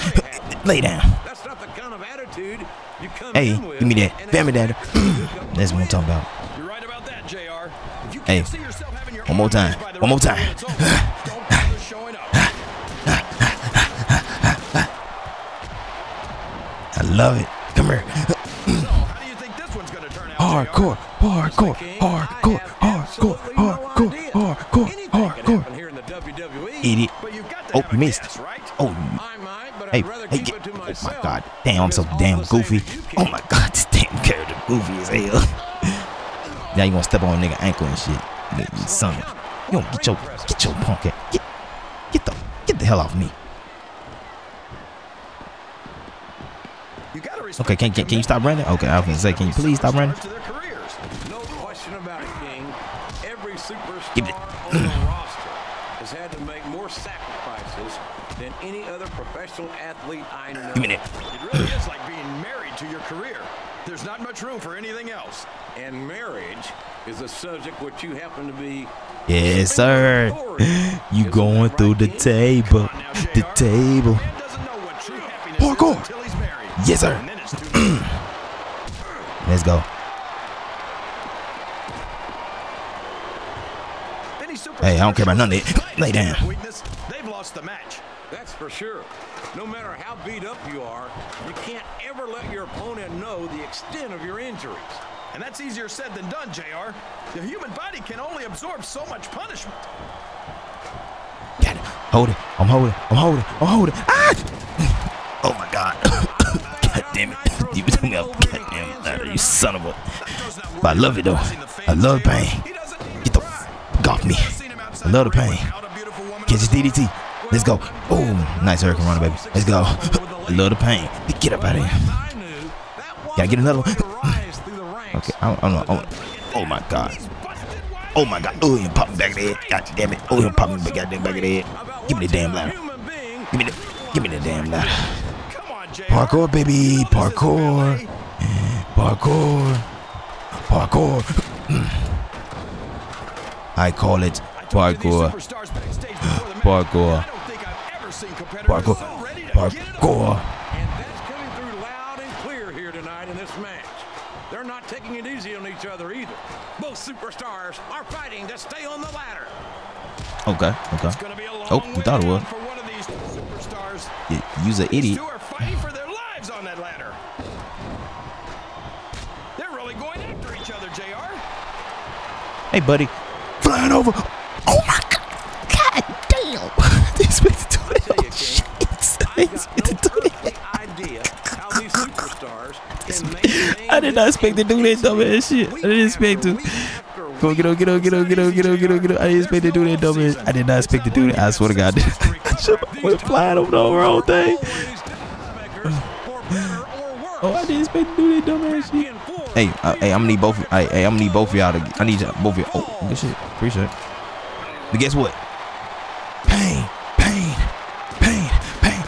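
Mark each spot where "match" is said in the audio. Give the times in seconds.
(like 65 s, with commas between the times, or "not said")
87 s, 153 s.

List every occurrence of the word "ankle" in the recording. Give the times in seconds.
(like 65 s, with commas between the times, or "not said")
37 s.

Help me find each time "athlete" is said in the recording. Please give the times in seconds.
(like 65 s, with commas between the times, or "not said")
59 s.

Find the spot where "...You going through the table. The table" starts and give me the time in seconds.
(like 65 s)
71 s.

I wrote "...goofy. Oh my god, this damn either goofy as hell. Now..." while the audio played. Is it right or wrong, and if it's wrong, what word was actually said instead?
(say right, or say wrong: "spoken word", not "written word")
wrong: "character", not "either".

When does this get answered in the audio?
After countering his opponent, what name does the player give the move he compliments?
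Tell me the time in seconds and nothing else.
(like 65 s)
118 s.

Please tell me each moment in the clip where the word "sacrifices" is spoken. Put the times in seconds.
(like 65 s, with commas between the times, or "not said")
56 s.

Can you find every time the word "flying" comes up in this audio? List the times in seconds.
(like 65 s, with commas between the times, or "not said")
173 s, 193 s.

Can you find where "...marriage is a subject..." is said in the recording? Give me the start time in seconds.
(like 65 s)
66 s.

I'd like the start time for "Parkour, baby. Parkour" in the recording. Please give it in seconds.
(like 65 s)
136 s.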